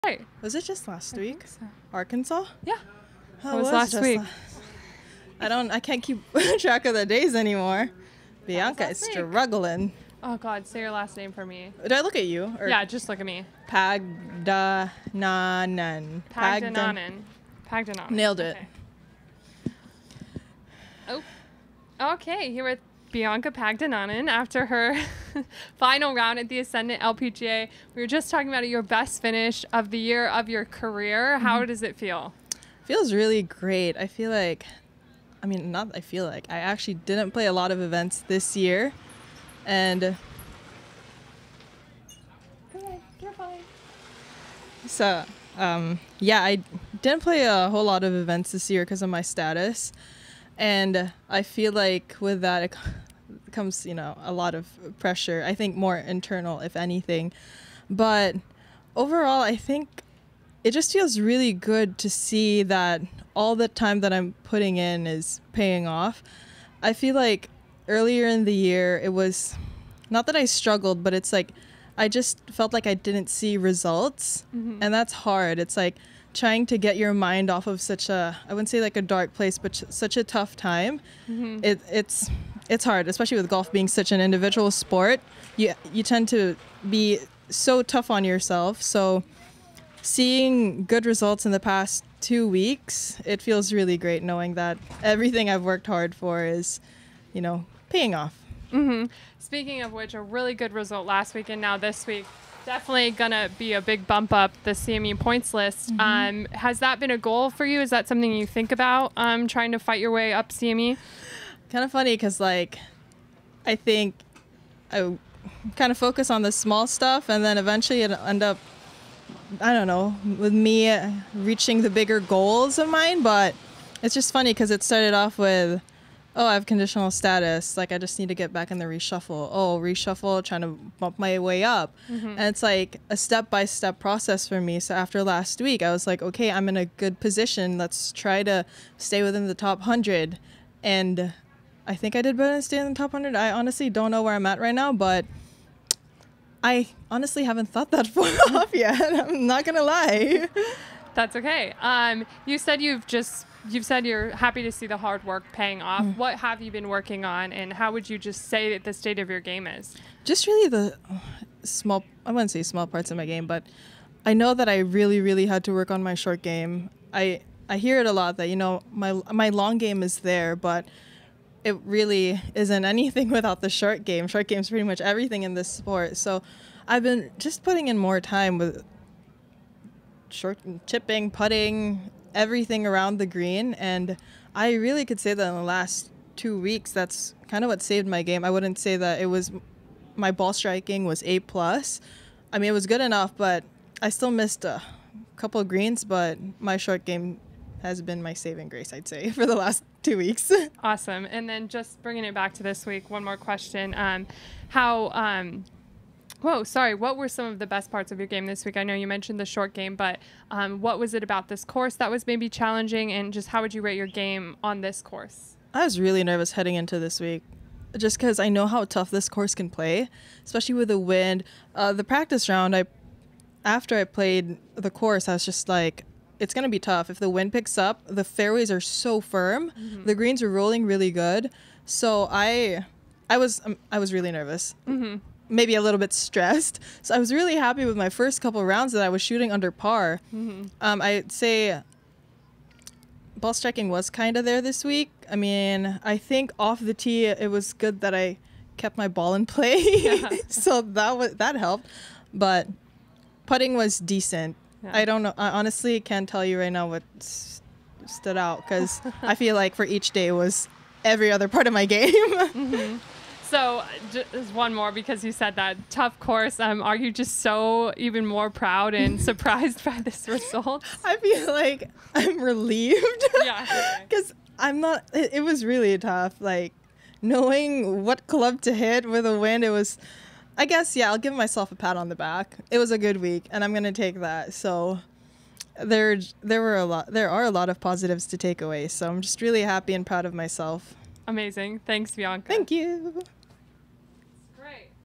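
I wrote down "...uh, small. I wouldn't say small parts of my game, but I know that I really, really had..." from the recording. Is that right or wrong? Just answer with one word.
right.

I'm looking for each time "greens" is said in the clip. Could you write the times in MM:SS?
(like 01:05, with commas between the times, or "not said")
03:03, 03:15, 03:50.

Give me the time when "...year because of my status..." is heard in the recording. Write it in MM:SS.
00:48.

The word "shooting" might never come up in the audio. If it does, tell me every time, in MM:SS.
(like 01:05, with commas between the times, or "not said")
03:59.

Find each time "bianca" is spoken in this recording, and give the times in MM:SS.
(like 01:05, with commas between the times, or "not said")
00:08, 00:23, 04:52.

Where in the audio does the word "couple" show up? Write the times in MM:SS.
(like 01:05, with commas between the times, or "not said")
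03:15, 03:58.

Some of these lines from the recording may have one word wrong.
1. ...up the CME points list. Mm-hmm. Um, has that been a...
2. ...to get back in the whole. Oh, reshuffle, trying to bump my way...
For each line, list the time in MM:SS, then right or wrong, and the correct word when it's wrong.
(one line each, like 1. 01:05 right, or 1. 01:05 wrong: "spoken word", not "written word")
1. 01:44 right
2. 02:08 wrong: "reshuffle", not "whole".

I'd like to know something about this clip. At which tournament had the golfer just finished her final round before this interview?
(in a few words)
Ascendant LPGA.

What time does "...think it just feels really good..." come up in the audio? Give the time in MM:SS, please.
00:59.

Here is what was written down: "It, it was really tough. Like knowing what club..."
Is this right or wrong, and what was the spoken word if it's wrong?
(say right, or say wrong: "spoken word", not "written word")
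right.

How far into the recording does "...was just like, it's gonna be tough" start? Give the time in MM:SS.
03:45.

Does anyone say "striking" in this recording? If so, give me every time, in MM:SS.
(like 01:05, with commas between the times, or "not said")
03:10, 04:03.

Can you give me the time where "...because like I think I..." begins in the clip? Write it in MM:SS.
01:52.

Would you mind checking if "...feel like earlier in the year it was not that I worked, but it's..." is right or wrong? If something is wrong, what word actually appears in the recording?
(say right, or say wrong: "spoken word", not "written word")
wrong: "struggled", not "worked".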